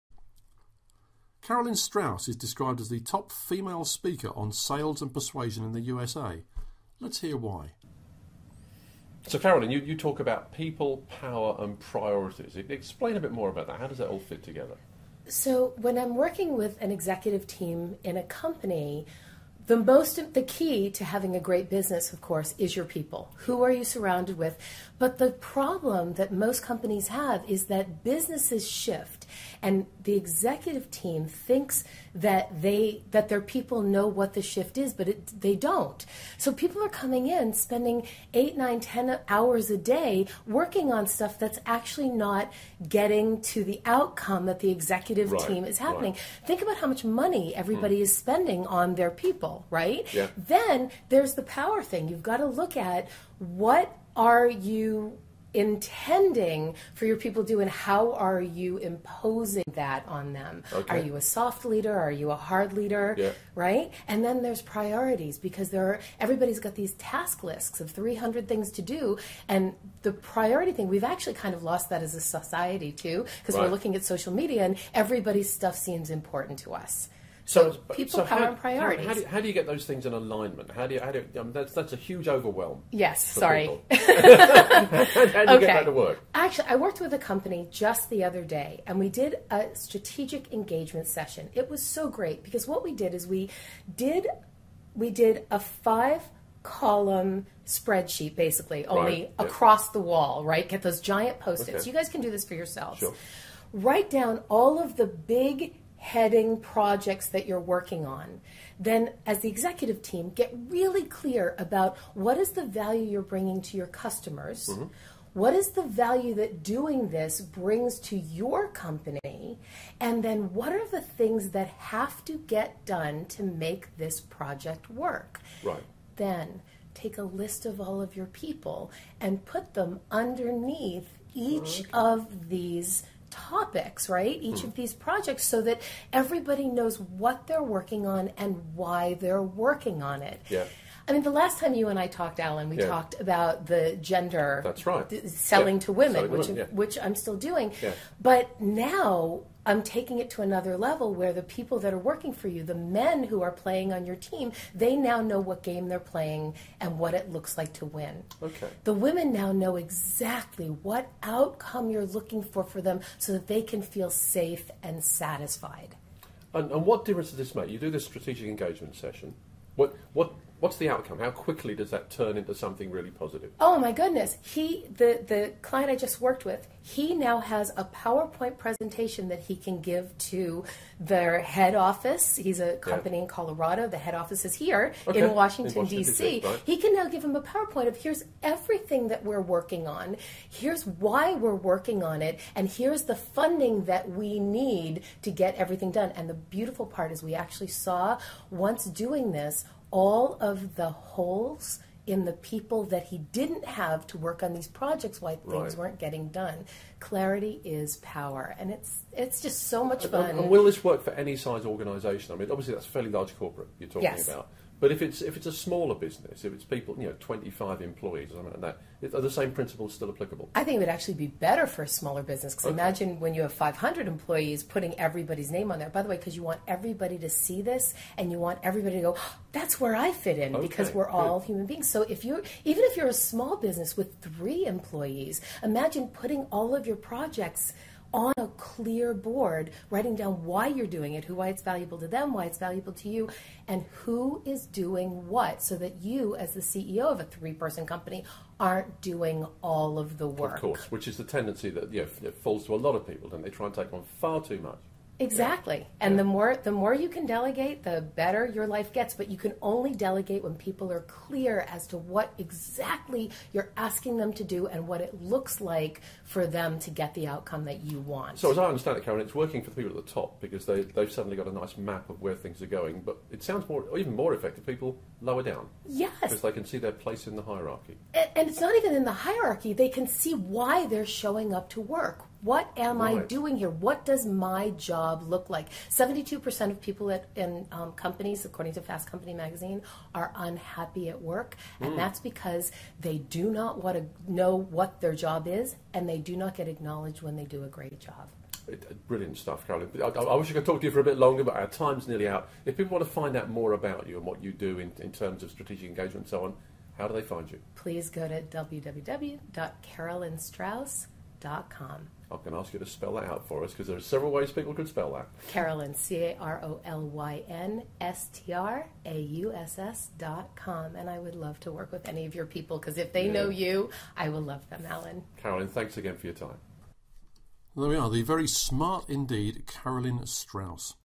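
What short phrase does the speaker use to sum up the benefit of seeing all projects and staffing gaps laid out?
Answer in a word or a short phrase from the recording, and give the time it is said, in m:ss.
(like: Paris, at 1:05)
Clarity is power, at 3:26.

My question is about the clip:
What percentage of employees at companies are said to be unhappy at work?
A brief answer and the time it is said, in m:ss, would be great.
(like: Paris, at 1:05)
72%, at 4:45.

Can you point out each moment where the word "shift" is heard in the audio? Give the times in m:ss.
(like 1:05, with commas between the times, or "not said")
0:28, 0:34.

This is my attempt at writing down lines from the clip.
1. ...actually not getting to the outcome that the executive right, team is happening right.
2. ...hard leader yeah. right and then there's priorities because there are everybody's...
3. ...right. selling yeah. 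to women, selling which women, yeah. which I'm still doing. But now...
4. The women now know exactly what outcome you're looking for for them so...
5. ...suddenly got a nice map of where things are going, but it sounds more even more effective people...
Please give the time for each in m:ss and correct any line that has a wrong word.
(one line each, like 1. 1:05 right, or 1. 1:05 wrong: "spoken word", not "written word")
1. 0:41 right
2. 1:02 right
3. 2:24 right
4. 2:38 right
5. 4:31 right.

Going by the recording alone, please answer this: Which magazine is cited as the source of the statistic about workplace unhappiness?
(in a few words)
Fast Company.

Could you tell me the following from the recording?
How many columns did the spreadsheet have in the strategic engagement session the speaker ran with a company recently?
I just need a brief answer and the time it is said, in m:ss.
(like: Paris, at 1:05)
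5, at 1:35.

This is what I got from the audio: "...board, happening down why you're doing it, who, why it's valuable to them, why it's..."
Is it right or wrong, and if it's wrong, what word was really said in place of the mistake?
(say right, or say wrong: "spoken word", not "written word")
wrong: "writing", not "happening".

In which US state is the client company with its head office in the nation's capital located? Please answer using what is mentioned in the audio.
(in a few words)
Colorado.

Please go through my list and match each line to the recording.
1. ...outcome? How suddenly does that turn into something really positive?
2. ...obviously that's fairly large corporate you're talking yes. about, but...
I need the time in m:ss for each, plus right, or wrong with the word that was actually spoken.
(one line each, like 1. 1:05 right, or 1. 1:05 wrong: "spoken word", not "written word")
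1. 2:50 wrong: "quickly", not "suddenly"
2. 3:32 right.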